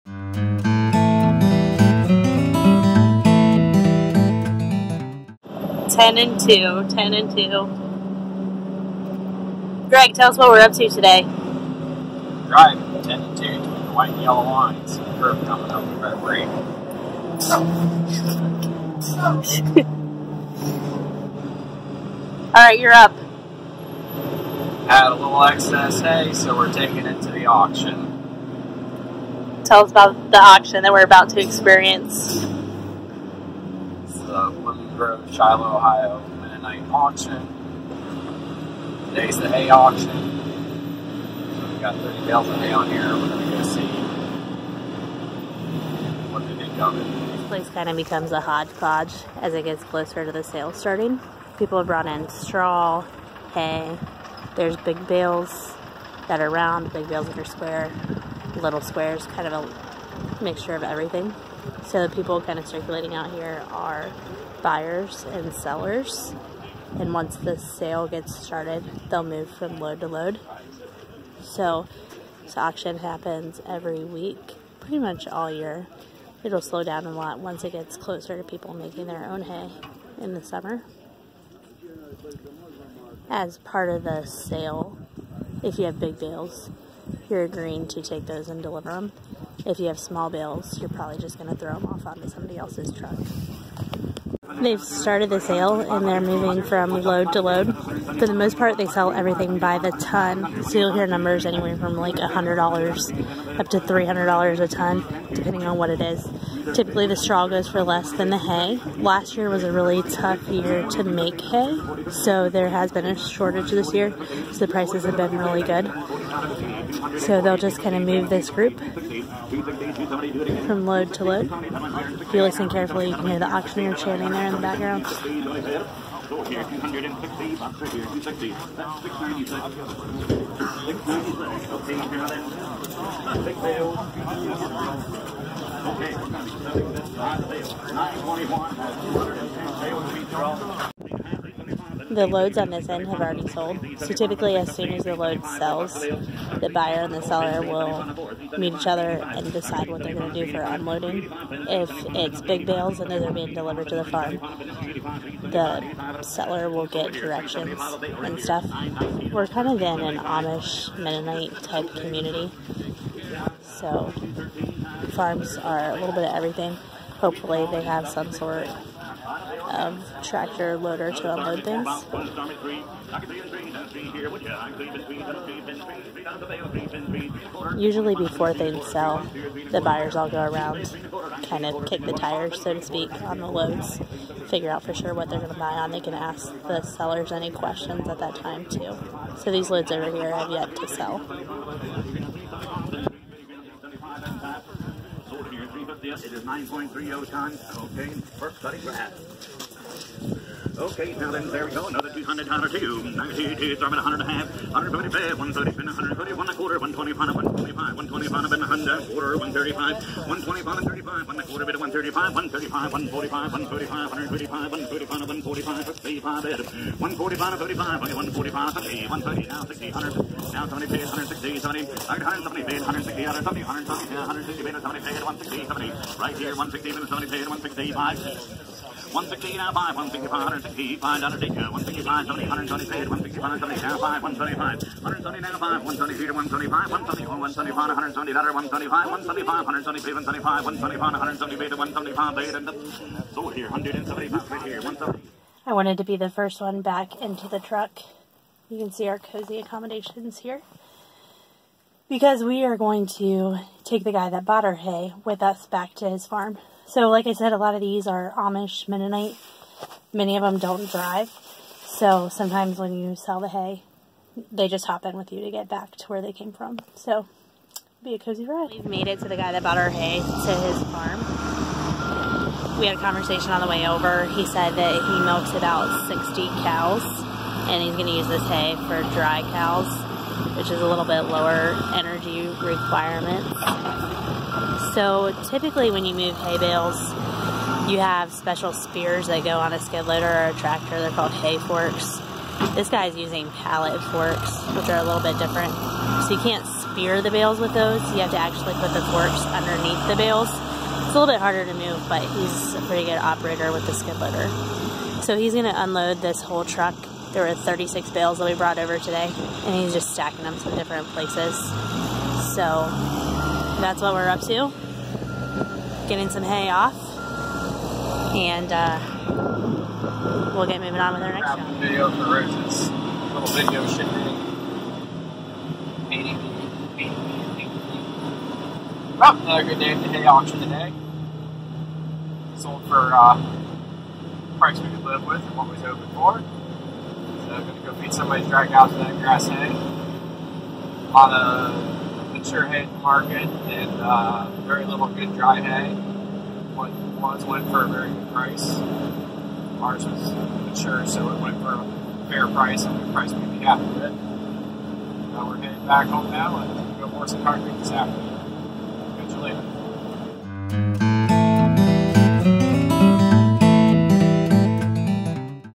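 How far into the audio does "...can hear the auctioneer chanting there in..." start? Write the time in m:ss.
2:03.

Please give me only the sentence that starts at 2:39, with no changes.
We're kind of in an Amish Mennonite type community.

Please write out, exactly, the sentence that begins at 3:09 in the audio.
So these loads over here have yet to sell.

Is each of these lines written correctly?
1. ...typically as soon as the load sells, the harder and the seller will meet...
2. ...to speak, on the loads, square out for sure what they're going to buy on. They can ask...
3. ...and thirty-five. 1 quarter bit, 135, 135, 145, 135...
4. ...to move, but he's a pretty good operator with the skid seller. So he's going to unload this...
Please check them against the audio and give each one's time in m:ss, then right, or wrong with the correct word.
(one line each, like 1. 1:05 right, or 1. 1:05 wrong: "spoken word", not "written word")
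1. 2:24 wrong: "buyer", not "harder"
2. 3:02 wrong: "figure", not "square"
3. 3:30 right
4. 5:01 wrong: "loader", not "seller".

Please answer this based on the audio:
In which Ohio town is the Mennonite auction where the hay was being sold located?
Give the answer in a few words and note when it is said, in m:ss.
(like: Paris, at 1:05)
Shiloh, at 0:35.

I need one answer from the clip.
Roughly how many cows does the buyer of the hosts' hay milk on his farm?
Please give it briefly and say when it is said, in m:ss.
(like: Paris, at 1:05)
60, at 4:36.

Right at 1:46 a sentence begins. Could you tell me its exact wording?
Typically, the straw goes for less than the hay.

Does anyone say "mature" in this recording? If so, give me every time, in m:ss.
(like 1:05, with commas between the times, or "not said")
5:42, 5:50.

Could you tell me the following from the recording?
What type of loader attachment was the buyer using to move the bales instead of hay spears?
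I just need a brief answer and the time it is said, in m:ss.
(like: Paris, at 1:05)
pallet forks, at 4:53.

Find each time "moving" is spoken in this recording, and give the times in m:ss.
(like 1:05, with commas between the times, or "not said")
1:36, 5:20.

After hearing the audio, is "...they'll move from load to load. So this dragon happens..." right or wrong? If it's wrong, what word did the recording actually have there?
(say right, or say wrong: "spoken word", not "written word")
wrong: "auction", not "dragon".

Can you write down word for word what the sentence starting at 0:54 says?
There's big bales that are round, big bales that are square little squares, kind of a mixture of everything.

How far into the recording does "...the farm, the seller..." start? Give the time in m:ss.
2:33.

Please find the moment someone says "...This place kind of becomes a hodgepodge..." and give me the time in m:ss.
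0:47.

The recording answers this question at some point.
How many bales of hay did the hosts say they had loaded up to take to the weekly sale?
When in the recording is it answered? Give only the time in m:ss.
0:41.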